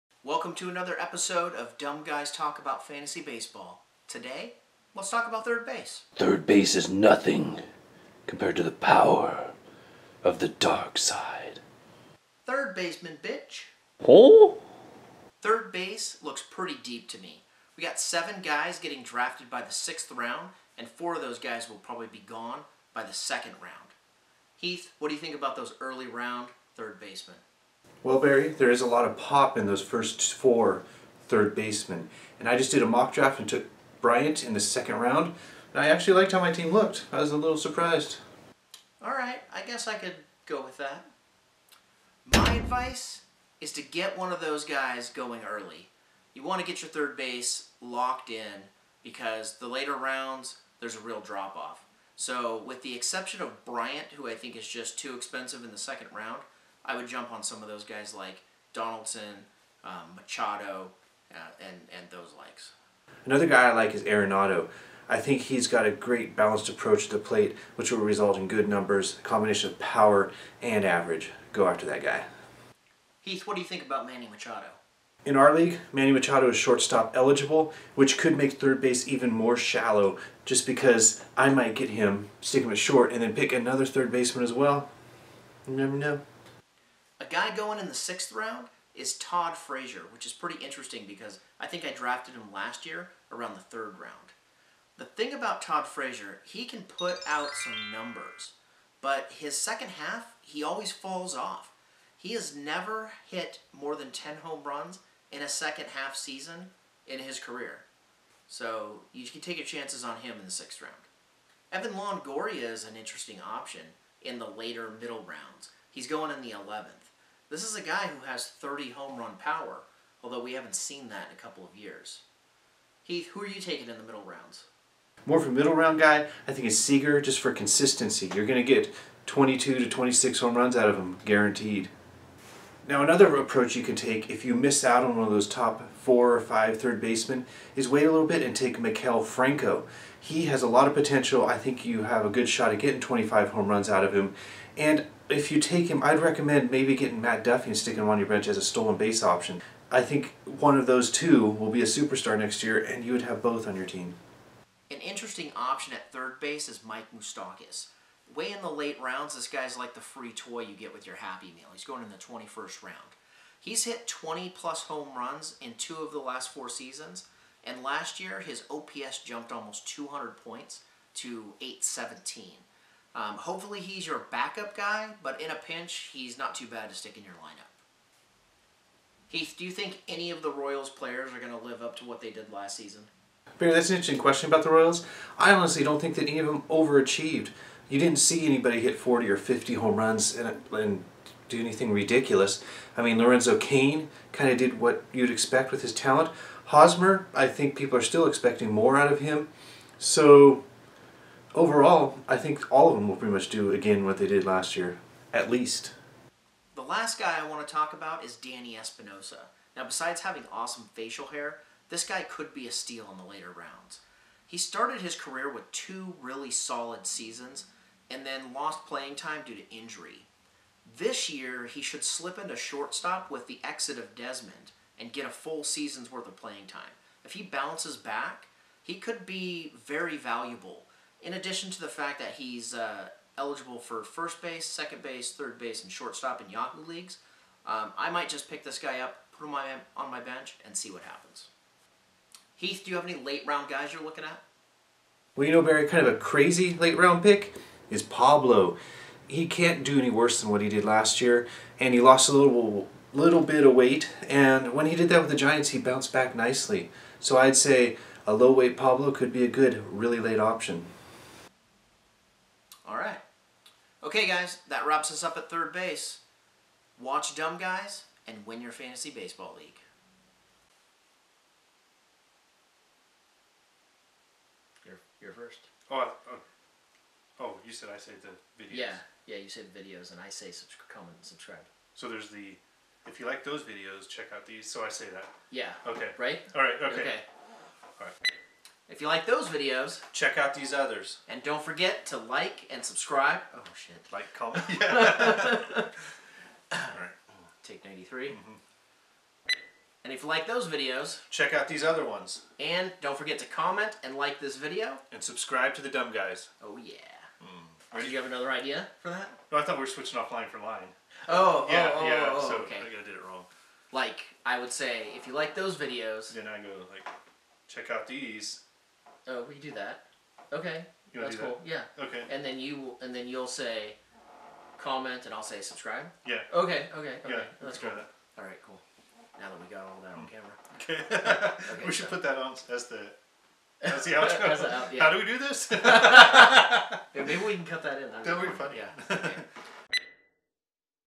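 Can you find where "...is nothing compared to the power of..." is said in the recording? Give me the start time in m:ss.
0:06.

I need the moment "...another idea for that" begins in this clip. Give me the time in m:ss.
5:08.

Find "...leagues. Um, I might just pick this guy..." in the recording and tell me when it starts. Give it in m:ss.
3:56.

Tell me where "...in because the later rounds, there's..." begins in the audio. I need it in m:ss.
0:48.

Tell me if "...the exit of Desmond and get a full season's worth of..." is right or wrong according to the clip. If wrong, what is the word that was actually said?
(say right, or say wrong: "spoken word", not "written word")
right.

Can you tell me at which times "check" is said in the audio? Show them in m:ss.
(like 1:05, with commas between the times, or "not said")
4:44, 4:50, 5:01, 5:17.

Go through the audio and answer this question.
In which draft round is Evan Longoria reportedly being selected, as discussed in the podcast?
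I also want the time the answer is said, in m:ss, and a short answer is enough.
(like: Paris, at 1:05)
11th, at 1:55.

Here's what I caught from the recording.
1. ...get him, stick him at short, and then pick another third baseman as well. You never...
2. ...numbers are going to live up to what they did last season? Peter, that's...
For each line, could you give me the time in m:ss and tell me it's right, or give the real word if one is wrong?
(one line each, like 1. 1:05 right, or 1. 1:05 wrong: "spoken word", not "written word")
1. 1:21 right
2. 3:00 wrong: "players", not "numbers".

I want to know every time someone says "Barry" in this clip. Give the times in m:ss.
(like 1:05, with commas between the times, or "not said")
0:28, 4:05.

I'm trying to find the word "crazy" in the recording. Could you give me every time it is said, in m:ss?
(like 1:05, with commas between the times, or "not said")
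4:06.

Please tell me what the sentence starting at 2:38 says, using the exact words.
Way in the late rounds, this guy's like the free toy you get with your Happy Meal.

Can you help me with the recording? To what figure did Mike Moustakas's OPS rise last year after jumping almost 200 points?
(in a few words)
817.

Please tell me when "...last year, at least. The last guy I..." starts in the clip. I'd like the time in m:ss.
3:24.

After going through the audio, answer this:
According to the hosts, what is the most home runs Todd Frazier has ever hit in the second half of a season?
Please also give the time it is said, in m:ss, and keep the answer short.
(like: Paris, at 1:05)
10, at 1:43.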